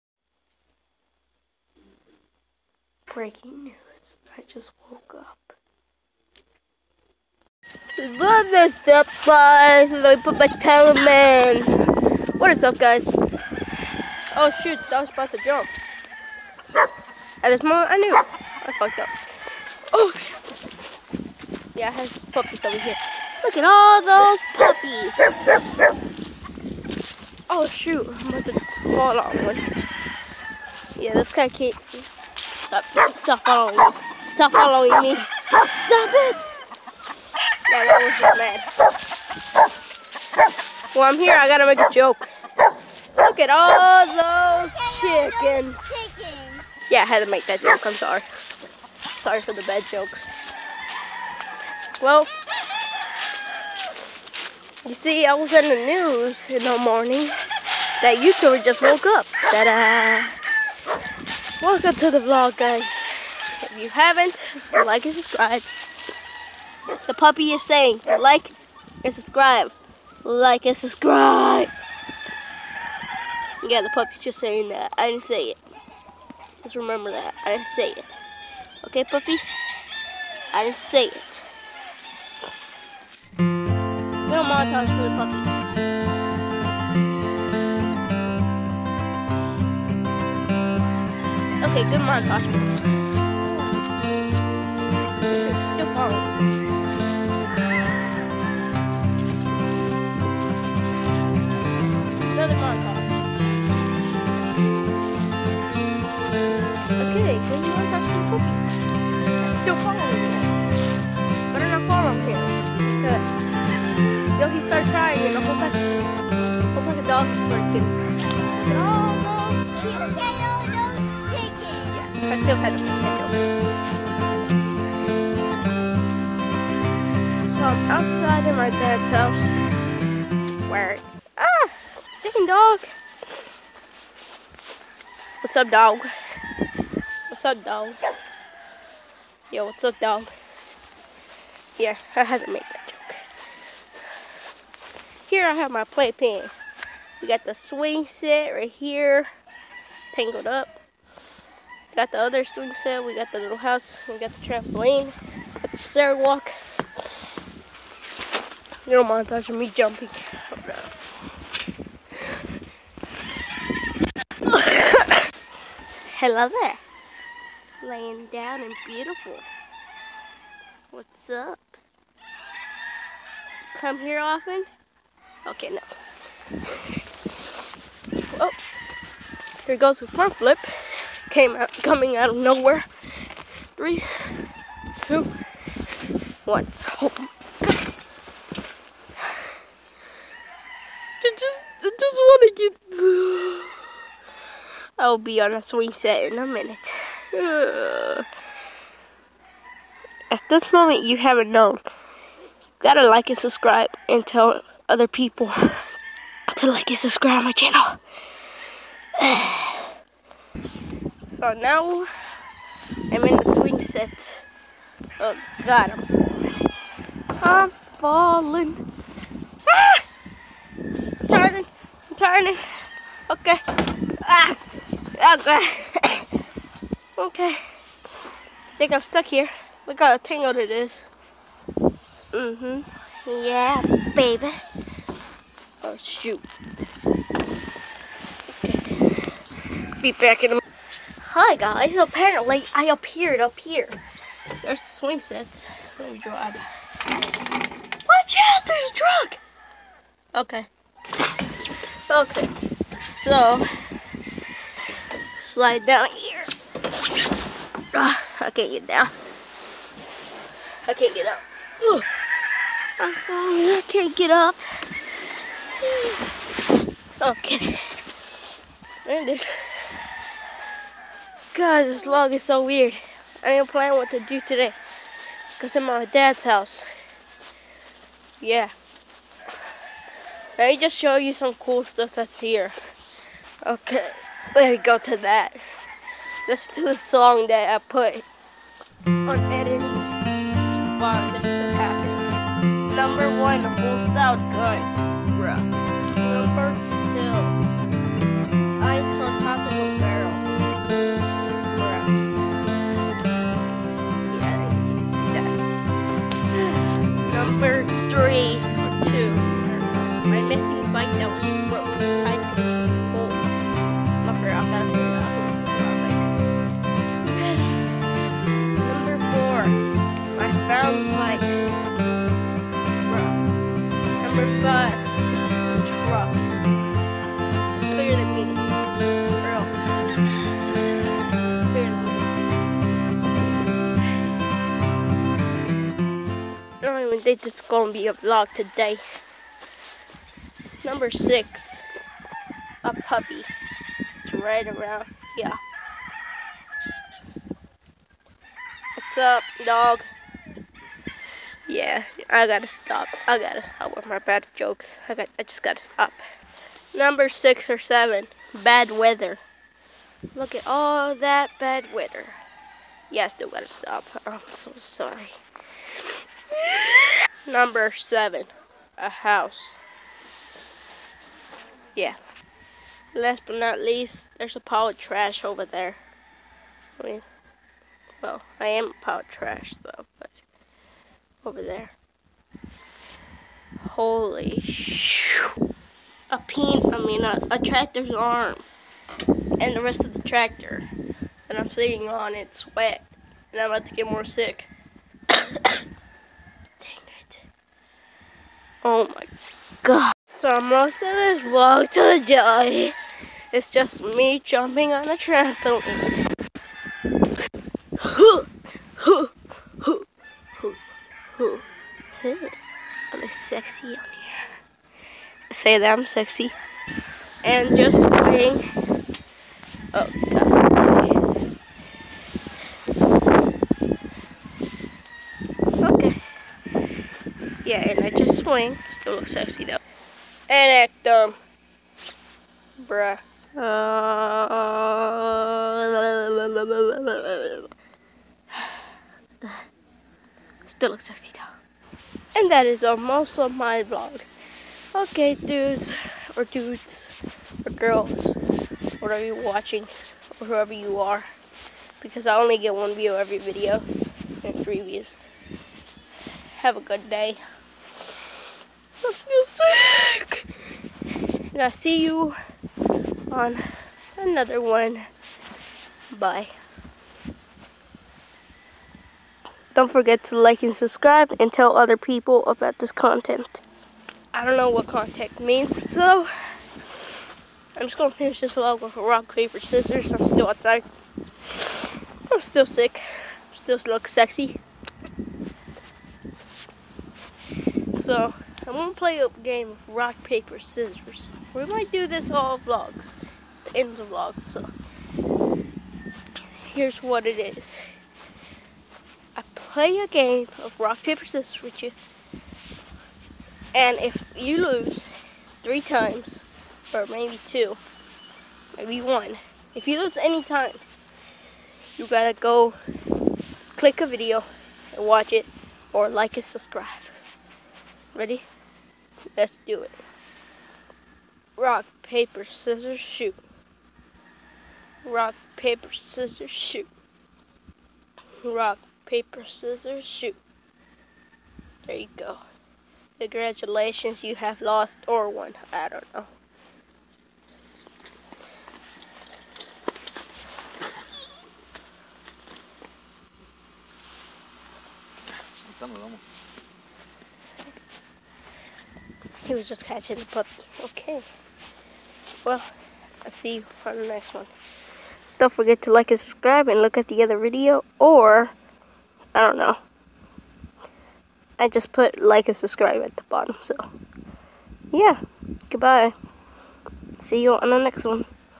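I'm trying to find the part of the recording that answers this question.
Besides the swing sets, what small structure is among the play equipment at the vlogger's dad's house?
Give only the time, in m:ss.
2:33.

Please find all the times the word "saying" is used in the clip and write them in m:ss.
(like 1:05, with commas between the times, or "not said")
1:07, 1:14.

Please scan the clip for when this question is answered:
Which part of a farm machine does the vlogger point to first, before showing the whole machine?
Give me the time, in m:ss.
6:27.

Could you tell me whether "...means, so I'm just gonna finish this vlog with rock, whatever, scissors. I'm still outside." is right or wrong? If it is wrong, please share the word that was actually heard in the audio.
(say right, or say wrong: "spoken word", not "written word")
wrong: "paper", not "whatever".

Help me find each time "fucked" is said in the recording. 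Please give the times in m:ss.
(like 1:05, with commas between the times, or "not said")
0:18.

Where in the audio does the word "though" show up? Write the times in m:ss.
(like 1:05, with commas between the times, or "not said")
6:19, 7:09, 7:21.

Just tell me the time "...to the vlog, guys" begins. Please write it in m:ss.
1:01.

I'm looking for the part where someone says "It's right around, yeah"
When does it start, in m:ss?
5:44.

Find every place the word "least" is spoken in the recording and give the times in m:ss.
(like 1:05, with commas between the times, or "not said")
6:13.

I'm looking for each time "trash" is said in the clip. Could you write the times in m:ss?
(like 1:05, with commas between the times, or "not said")
6:14, 6:19.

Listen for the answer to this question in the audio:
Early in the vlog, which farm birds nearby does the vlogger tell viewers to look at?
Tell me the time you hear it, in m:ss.
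0:45.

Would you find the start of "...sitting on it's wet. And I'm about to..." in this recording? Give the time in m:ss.
6:31.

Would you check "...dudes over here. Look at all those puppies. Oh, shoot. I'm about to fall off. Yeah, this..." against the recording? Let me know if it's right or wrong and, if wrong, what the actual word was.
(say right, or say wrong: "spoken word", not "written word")
wrong: "puppies", not "dudes".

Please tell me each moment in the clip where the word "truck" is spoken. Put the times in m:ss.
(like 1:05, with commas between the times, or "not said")
4:08.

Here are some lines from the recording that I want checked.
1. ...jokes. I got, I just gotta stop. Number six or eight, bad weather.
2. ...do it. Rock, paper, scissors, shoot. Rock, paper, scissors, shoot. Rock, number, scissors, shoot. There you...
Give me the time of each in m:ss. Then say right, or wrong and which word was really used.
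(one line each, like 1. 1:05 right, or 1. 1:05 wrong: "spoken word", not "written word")
1. 5:54 wrong: "seven", not "eight"
2. 8:39 wrong: "paper", not "number".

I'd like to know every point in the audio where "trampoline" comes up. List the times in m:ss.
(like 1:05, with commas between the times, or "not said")
2:34, 6:45.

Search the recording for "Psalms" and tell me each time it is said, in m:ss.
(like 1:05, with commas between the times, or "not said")
not said.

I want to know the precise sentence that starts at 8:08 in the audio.
So, I'm gonna play a game of rock, paper, scissors.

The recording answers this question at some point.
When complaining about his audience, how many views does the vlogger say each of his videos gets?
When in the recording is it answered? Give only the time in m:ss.
7:32.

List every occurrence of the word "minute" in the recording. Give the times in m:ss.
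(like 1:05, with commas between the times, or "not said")
3:16.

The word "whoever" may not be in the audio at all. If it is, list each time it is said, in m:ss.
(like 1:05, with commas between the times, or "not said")
7:30.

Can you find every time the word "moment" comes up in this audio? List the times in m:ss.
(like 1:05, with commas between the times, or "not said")
0:17, 3:20.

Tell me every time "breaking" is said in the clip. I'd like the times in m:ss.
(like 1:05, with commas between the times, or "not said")
0:03.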